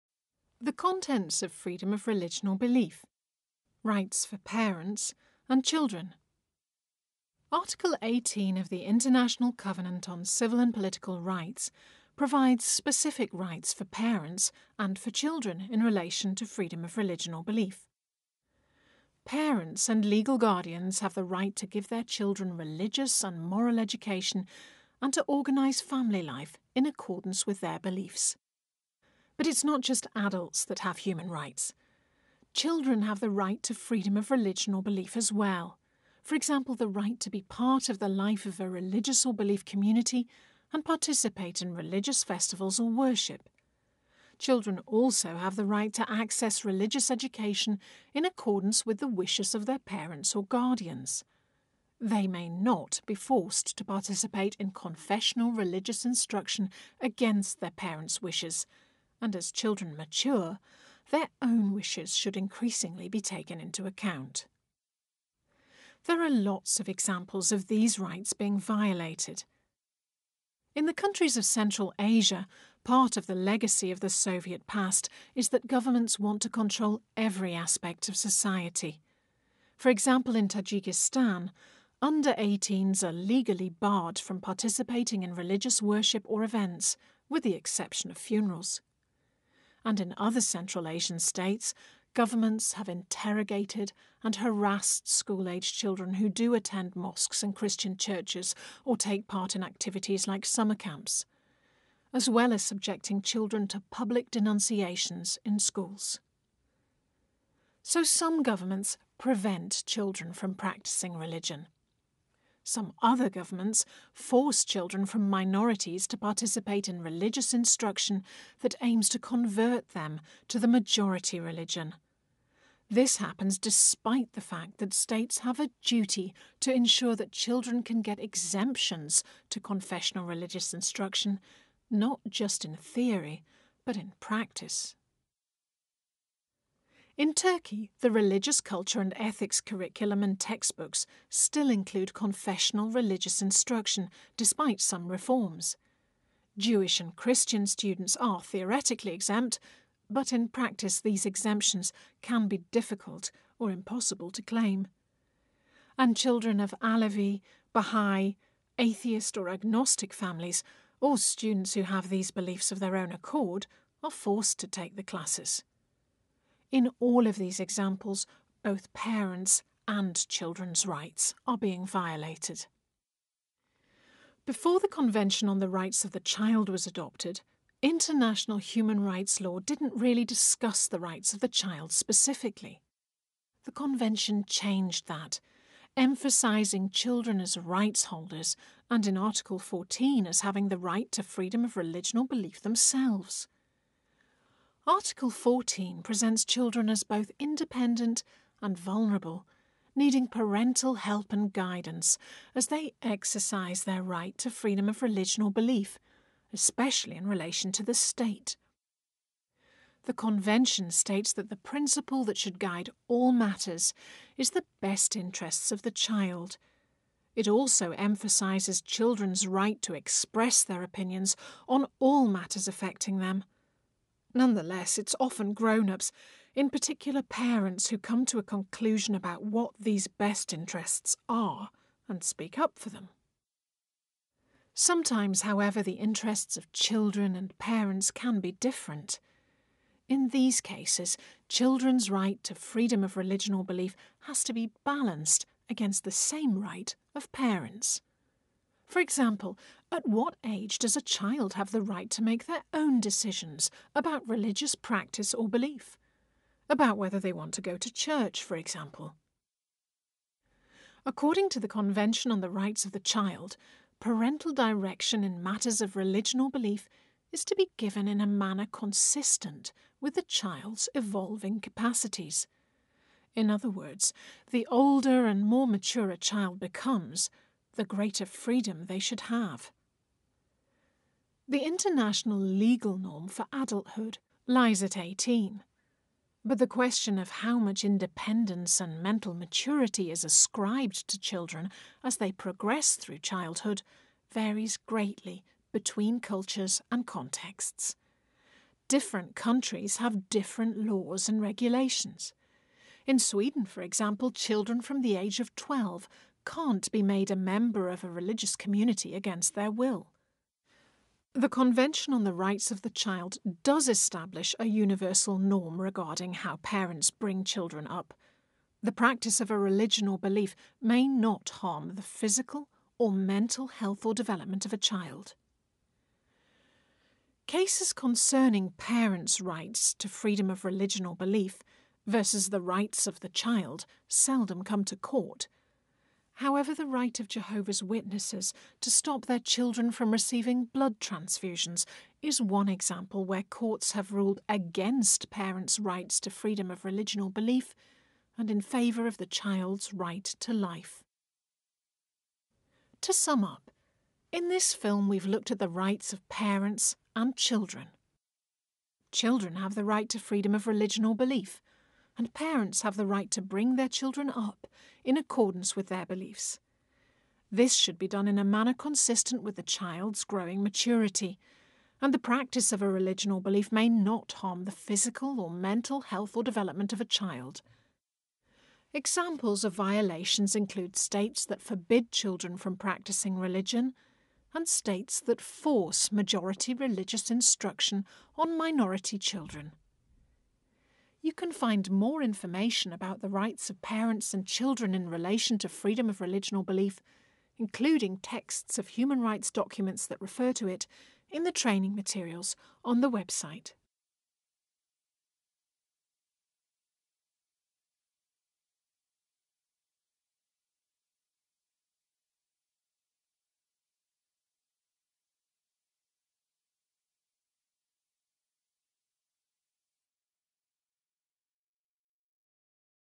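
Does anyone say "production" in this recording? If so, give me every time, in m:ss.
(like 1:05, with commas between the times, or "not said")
not said.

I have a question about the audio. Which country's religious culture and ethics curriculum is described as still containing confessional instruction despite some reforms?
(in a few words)
Turkey.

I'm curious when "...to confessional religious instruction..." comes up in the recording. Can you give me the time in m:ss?
2:09.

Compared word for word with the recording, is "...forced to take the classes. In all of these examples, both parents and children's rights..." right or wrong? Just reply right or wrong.
right.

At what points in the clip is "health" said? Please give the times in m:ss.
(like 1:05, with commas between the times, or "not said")
5:23, 6:16.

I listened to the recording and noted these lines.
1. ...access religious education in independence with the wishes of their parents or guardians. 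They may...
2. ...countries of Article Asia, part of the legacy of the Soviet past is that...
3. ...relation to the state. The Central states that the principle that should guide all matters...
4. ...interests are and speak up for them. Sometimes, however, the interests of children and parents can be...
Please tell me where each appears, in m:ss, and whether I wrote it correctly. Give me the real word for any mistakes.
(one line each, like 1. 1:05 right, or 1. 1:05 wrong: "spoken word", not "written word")
1. 0:46 wrong: "accordance", not "independence"
2. 1:10 wrong: "Central", not "Article"
3. 3:27 wrong: "Convention", not "Central"
4. 3:50 right.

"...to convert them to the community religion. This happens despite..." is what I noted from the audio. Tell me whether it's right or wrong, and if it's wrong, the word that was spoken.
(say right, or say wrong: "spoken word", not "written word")
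wrong: "majority", not "community".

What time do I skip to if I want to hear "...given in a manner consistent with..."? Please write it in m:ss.
4:27.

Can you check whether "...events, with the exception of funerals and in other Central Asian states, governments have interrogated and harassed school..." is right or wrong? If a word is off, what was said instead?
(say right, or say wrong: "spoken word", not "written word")
right.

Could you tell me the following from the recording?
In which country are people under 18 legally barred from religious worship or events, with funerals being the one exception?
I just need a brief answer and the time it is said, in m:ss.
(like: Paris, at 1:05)
Tajikistan, at 1:20.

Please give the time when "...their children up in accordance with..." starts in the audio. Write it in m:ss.
6:03.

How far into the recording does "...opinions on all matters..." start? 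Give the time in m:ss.
3:40.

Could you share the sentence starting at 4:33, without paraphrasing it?
In other words, the older and more mature a child becomes, the greater freedom they should have.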